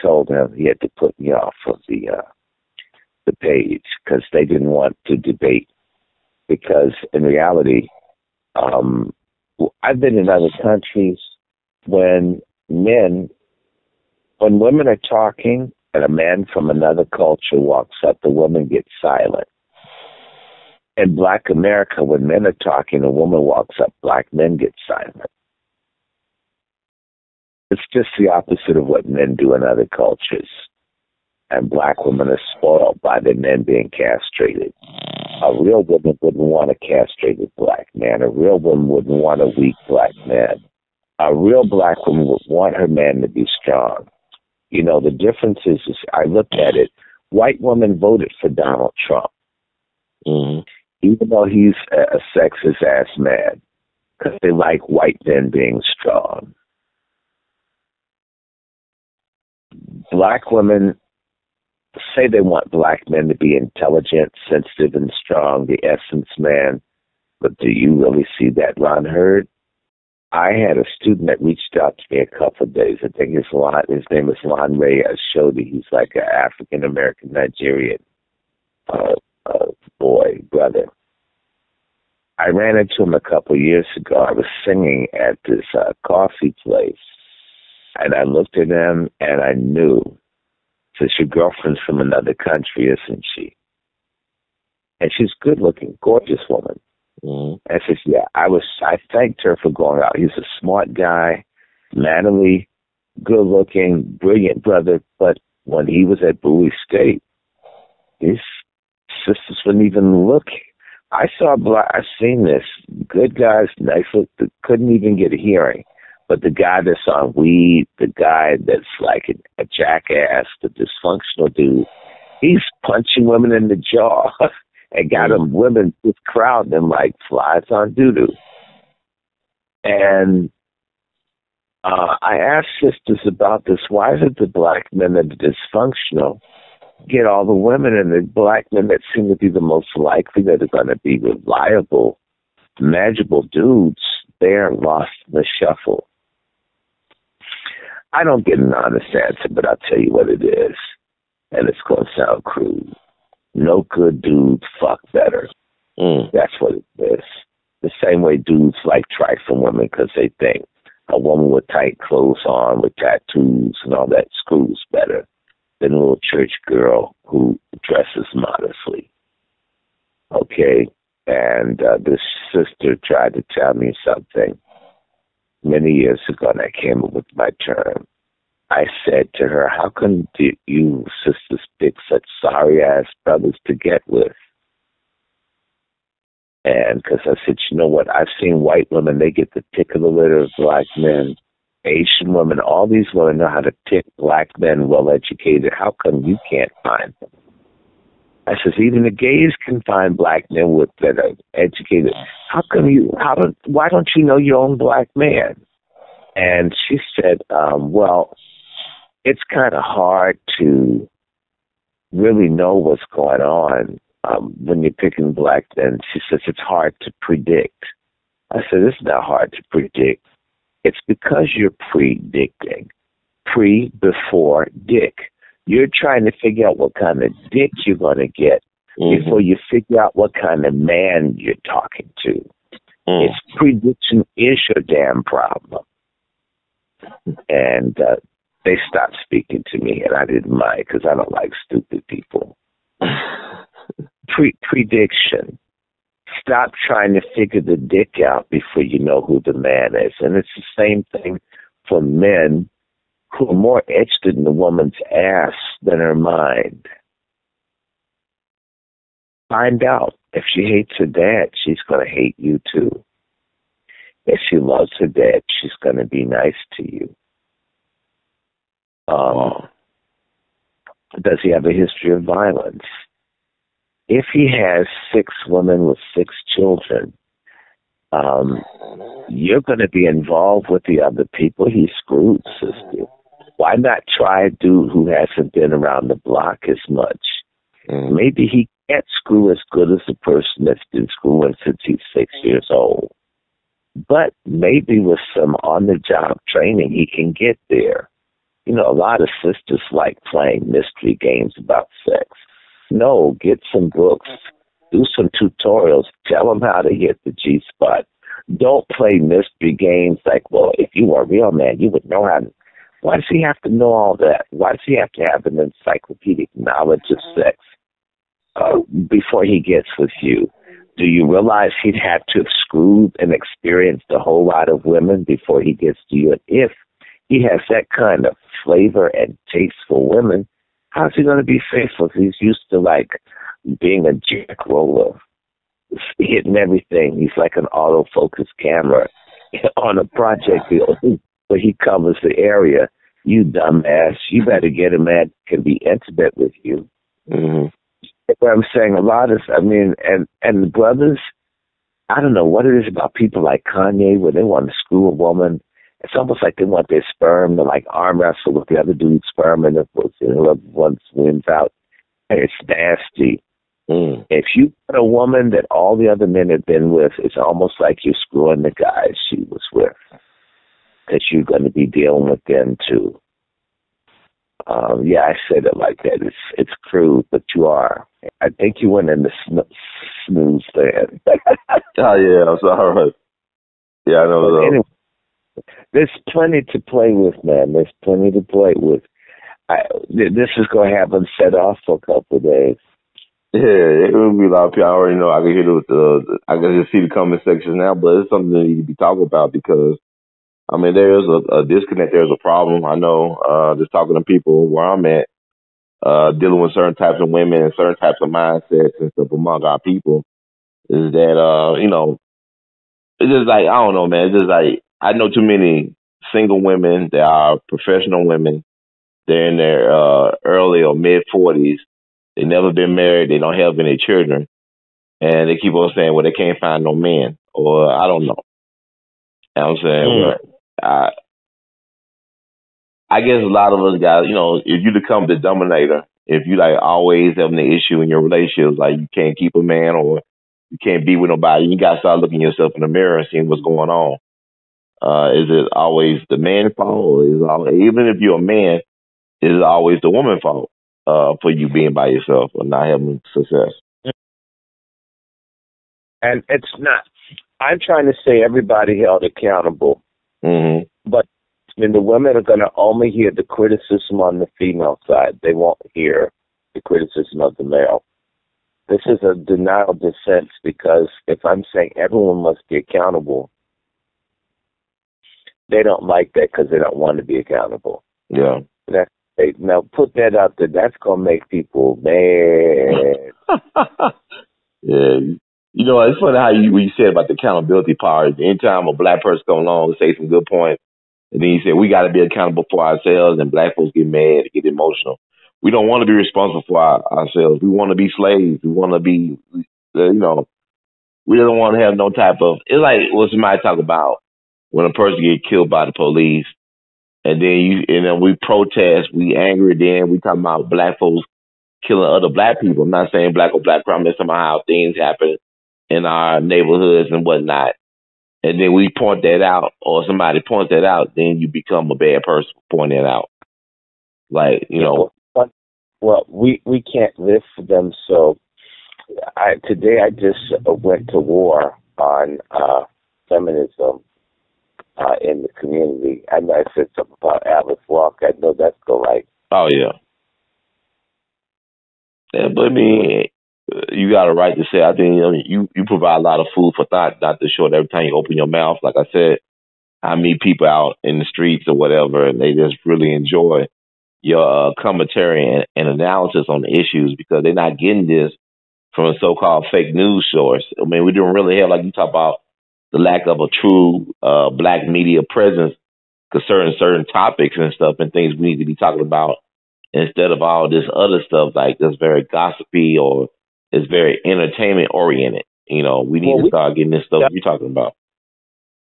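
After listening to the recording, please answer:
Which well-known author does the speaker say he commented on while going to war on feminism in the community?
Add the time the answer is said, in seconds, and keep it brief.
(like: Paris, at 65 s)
Alice Walker, at 537 s.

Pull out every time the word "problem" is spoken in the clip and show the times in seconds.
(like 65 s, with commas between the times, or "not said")
235 s, 402 s.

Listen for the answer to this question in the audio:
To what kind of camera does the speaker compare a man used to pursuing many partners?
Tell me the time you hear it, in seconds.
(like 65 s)
337 s.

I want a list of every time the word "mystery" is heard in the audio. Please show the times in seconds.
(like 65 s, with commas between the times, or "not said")
300 s, 309 s.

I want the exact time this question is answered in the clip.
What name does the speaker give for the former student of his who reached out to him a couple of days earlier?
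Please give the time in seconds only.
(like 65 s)
74 s.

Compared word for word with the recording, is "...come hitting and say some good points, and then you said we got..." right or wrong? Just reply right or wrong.
wrong.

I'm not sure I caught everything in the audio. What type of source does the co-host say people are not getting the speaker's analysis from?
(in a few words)
Fake news source.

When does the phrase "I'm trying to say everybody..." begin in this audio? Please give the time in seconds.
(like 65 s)
457 s.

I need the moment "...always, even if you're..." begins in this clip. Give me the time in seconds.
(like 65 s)
447 s.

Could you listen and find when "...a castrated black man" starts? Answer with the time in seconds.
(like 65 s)
36 s.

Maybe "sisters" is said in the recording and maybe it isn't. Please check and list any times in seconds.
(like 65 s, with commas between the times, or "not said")
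109 s, 132 s, 172 s, 181 s, 282 s, 299 s.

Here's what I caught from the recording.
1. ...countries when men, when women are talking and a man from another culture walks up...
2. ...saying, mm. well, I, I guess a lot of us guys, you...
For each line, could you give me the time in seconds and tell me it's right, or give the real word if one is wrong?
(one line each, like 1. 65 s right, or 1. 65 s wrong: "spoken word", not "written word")
1. 10 s right
2. 429 s right.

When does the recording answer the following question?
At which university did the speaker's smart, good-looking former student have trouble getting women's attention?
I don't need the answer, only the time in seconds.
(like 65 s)
106 s.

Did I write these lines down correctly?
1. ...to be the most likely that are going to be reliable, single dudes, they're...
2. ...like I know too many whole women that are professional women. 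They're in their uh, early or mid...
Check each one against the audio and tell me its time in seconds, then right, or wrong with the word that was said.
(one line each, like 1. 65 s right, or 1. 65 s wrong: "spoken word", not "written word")
1. 139 s wrong: "manageable", not "single"
2. 414 s wrong: "single", not "whole".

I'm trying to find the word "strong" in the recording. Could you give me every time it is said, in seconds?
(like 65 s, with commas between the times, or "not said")
43 s, 55 s, 65 s.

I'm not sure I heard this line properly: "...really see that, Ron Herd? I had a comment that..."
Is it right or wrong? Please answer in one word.
wrong.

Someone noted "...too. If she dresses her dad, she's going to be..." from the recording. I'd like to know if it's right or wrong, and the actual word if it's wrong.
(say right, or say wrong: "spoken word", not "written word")
wrong: "loves", not "dresses".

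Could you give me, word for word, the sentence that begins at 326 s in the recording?
And if he has that kind of flavor and taste for women, How's he going to be faithful?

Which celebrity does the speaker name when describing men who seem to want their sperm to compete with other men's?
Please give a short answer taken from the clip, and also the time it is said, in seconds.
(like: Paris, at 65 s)
Kanye, at 353 s.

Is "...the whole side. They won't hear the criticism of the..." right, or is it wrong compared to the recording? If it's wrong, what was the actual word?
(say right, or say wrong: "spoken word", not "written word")
wrong: "female", not "whole".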